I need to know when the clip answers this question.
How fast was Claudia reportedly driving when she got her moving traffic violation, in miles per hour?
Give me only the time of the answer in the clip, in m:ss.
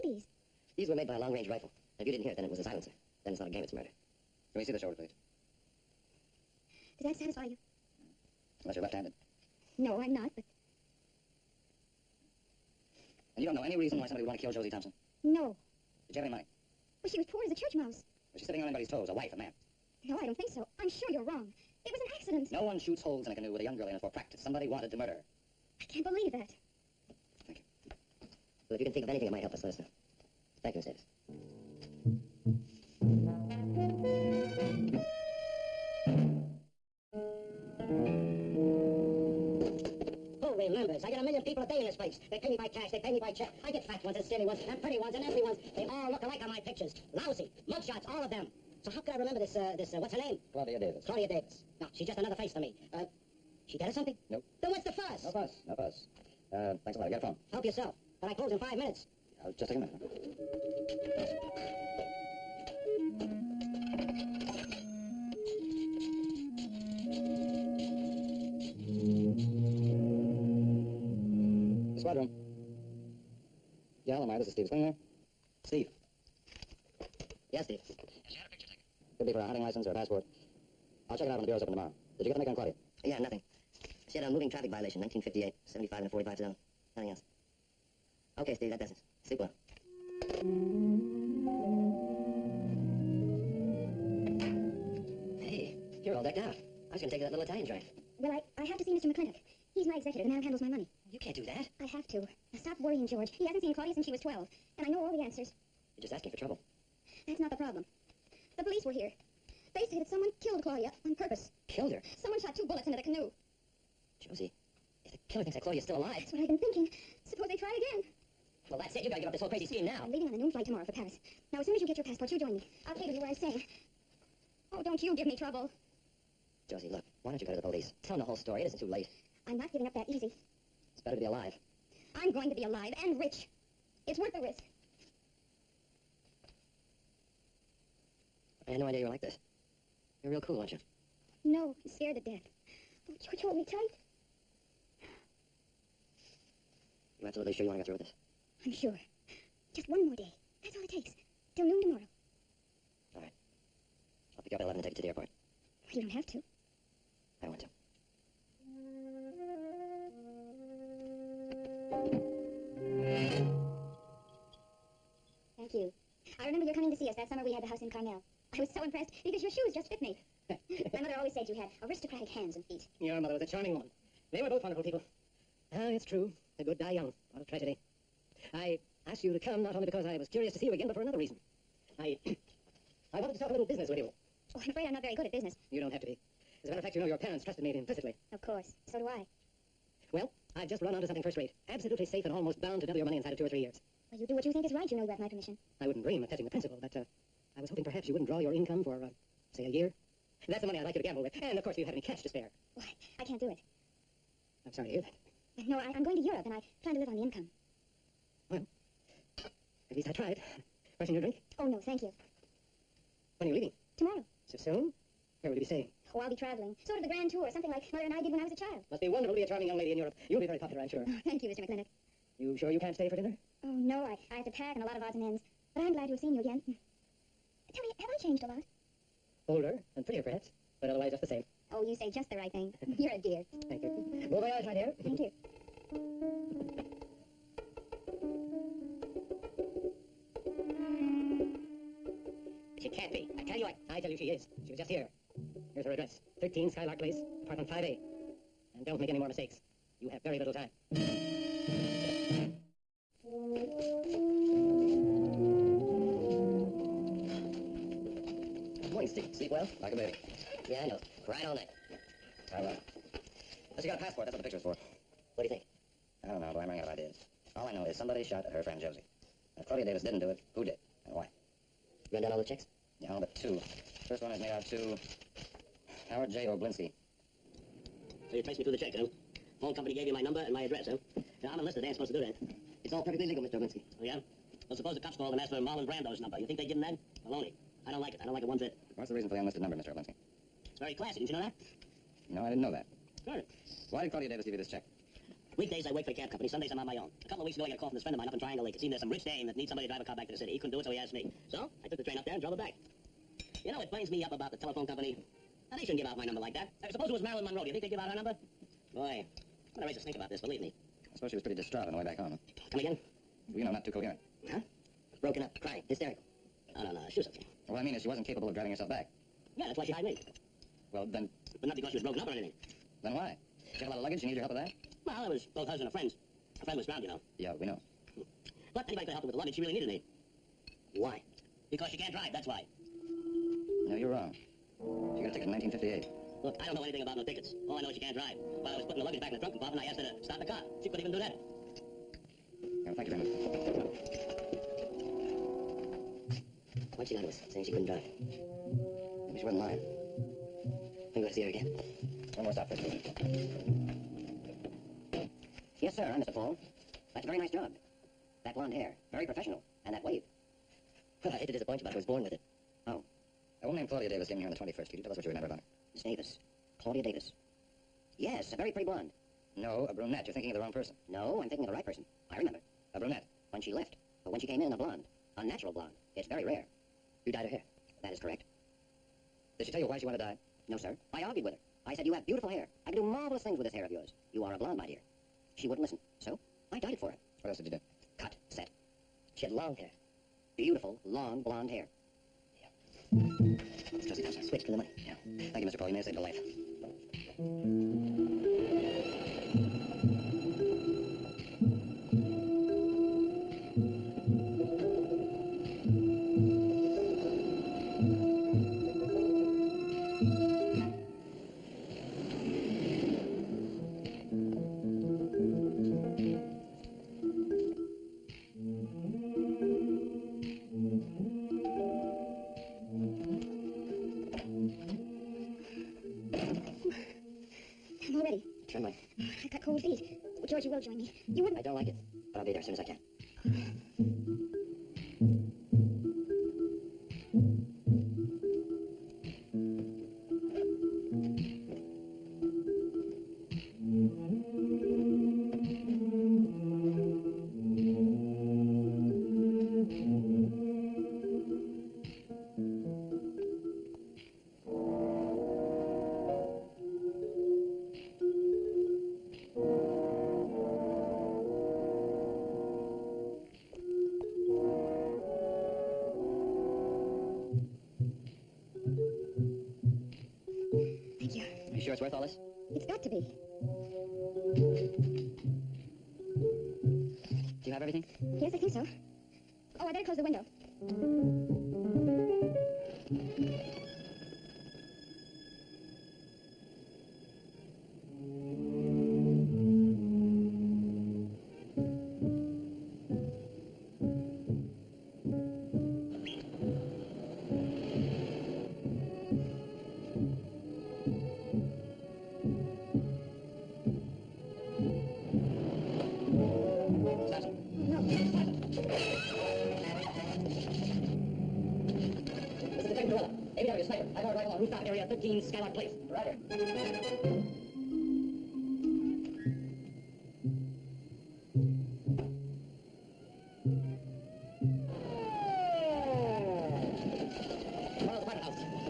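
1:25.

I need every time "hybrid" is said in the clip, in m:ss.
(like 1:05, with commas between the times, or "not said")
not said.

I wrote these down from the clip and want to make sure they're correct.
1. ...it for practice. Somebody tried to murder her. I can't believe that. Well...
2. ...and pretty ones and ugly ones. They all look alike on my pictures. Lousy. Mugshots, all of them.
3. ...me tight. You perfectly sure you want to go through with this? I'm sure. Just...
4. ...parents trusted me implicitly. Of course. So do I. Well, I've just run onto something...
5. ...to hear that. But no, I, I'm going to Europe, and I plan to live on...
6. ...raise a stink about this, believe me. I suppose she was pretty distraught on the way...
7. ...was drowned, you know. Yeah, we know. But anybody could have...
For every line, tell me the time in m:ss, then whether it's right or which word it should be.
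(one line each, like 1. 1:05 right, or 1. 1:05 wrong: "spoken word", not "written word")
1. 0:23 wrong: "wanted", not "tried"
2. 0:44 right
3. 2:23 wrong: "absolutely", not "perfectly"
4. 3:07 right
5. 3:24 right
6. 5:09 right
7. 5:26 right.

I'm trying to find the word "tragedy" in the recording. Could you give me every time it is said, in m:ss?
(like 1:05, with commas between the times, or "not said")
2:57.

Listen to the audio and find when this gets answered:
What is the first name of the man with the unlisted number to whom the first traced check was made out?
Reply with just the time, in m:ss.
4:36.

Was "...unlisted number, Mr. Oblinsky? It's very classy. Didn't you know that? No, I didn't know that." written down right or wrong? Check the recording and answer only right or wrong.
right.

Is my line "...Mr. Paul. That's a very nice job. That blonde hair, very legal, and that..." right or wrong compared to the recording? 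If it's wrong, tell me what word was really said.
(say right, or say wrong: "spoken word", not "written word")
wrong: "professional", not "legal".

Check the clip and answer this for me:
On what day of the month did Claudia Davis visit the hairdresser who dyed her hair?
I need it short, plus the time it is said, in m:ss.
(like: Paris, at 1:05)
21st, at 6:04.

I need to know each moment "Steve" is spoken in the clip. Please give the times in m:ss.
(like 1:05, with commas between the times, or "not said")
1:28, 4:19.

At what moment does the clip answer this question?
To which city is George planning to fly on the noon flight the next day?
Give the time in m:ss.
2:00.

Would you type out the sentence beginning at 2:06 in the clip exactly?
Josie, look, why don't you go to the police?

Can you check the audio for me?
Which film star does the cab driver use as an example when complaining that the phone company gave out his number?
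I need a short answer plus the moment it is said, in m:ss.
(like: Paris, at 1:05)
Marlon Brando, at 4:45.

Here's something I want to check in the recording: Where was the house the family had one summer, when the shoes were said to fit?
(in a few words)
Carmel.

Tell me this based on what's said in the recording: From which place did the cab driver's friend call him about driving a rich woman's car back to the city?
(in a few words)
Triangle Lake.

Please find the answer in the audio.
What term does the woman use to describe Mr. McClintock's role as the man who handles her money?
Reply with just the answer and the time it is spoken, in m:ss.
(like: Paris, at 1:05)
Executor, at 1:39.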